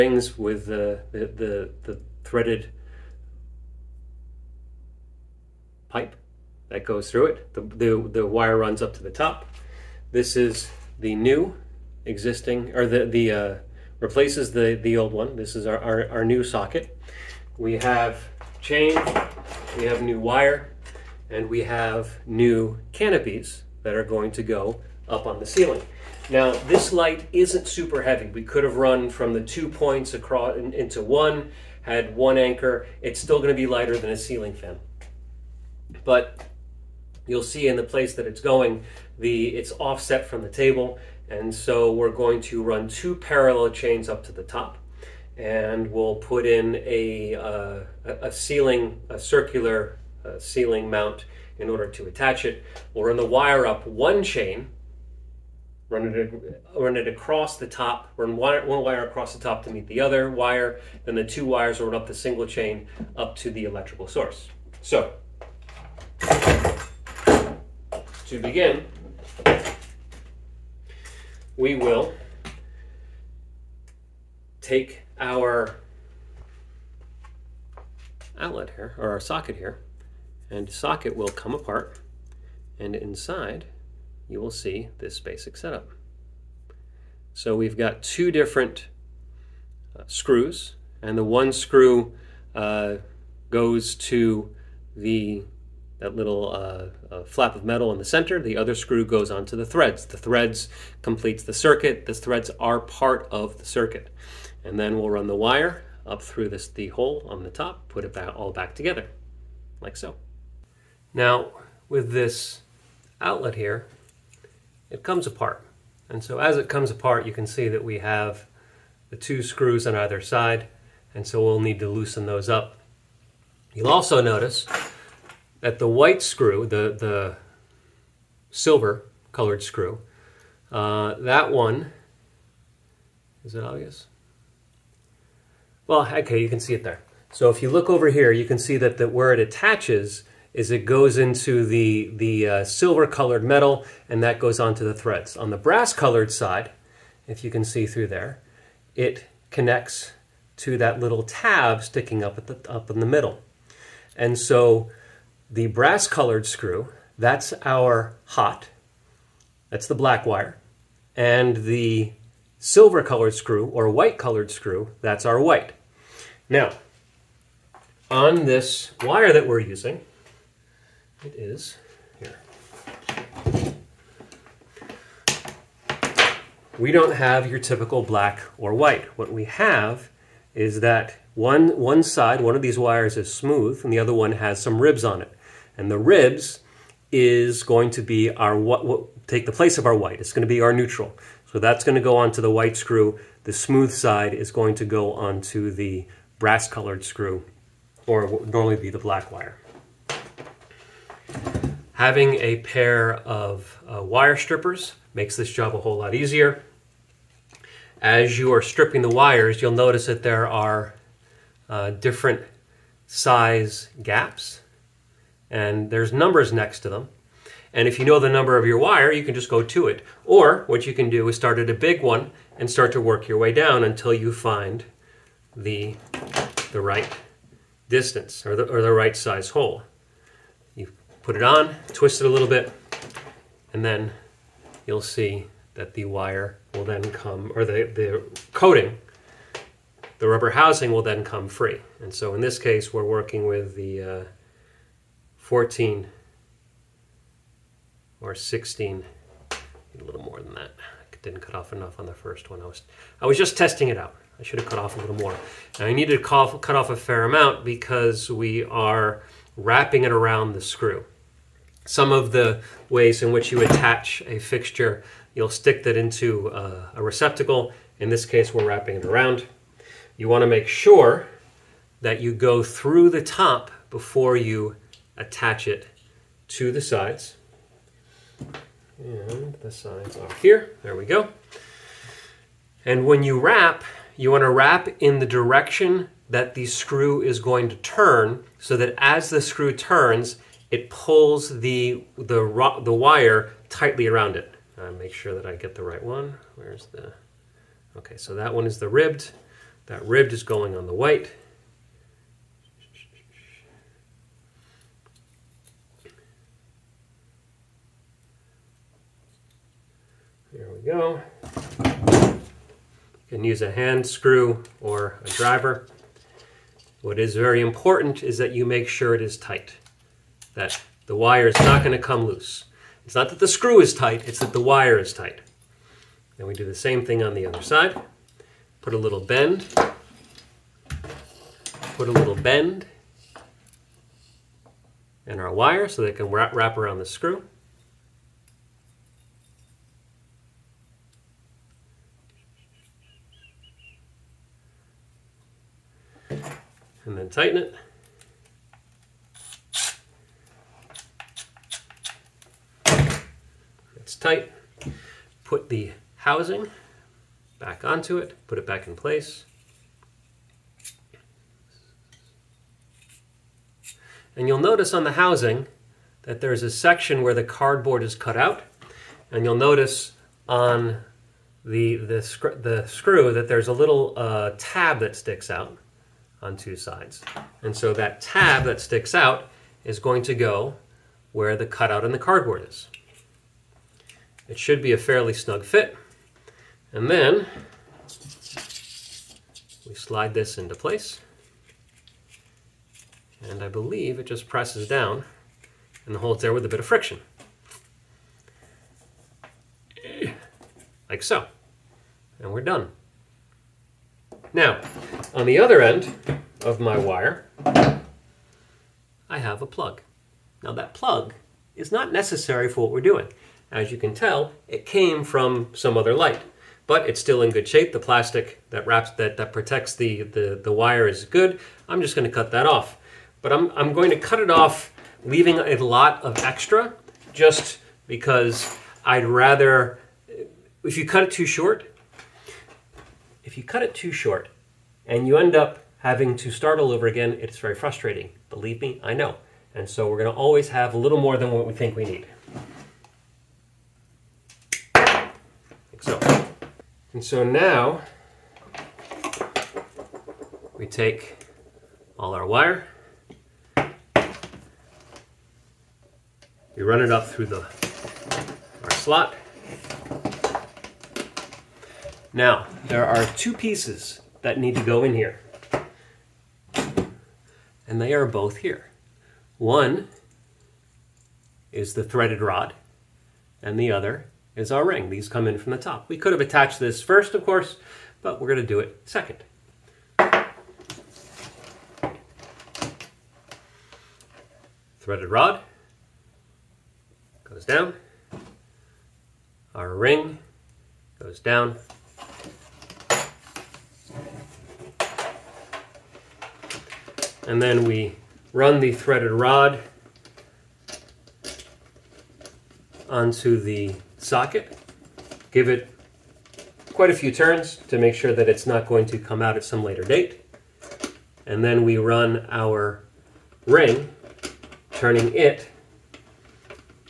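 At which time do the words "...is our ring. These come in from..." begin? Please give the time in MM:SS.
07:54.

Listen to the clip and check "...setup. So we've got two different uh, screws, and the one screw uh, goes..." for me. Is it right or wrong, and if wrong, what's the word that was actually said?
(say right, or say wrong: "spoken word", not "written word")
right.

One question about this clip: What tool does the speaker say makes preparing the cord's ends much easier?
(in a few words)
wire strippers.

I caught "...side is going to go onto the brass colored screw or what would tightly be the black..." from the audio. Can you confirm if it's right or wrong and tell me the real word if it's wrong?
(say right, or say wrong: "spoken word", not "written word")
wrong: "normally", not "tightly".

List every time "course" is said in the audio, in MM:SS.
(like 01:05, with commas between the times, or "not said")
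07:57.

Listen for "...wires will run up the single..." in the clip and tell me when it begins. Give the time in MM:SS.
01:01.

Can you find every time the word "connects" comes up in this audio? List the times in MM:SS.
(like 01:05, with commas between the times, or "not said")
02:29.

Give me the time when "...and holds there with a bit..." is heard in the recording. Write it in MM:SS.
06:36.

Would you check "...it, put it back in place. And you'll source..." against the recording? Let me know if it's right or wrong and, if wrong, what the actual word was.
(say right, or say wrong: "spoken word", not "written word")
wrong: "notice", not "source".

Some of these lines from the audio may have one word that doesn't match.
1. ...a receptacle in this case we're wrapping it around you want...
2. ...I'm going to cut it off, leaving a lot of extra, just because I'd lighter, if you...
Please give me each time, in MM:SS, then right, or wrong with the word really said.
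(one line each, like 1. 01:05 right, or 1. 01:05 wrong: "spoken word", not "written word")
1. 04:26 right
2. 07:03 wrong: "rather", not "lighter".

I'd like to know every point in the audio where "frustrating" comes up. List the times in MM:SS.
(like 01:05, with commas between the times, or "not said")
07:17.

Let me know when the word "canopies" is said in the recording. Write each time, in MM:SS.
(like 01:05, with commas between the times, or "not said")
00:22.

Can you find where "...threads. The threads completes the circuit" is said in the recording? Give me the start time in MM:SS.
01:39.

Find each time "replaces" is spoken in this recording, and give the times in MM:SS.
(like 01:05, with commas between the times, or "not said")
00:13.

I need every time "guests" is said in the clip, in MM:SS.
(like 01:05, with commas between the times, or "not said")
not said.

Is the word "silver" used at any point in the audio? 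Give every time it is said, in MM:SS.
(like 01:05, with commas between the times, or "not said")
02:08, 02:22, 02:42.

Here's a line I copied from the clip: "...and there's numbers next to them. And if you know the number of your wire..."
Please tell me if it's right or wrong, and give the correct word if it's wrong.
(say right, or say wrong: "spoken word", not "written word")
right.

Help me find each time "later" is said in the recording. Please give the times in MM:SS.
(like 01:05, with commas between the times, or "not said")
08:29.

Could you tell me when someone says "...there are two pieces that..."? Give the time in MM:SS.
07:42.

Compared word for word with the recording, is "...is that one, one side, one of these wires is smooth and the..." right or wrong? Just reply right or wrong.
right.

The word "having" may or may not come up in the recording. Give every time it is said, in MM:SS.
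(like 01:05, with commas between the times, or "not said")
03:21, 07:16.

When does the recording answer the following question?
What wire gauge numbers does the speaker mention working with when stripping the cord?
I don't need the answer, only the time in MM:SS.
04:05.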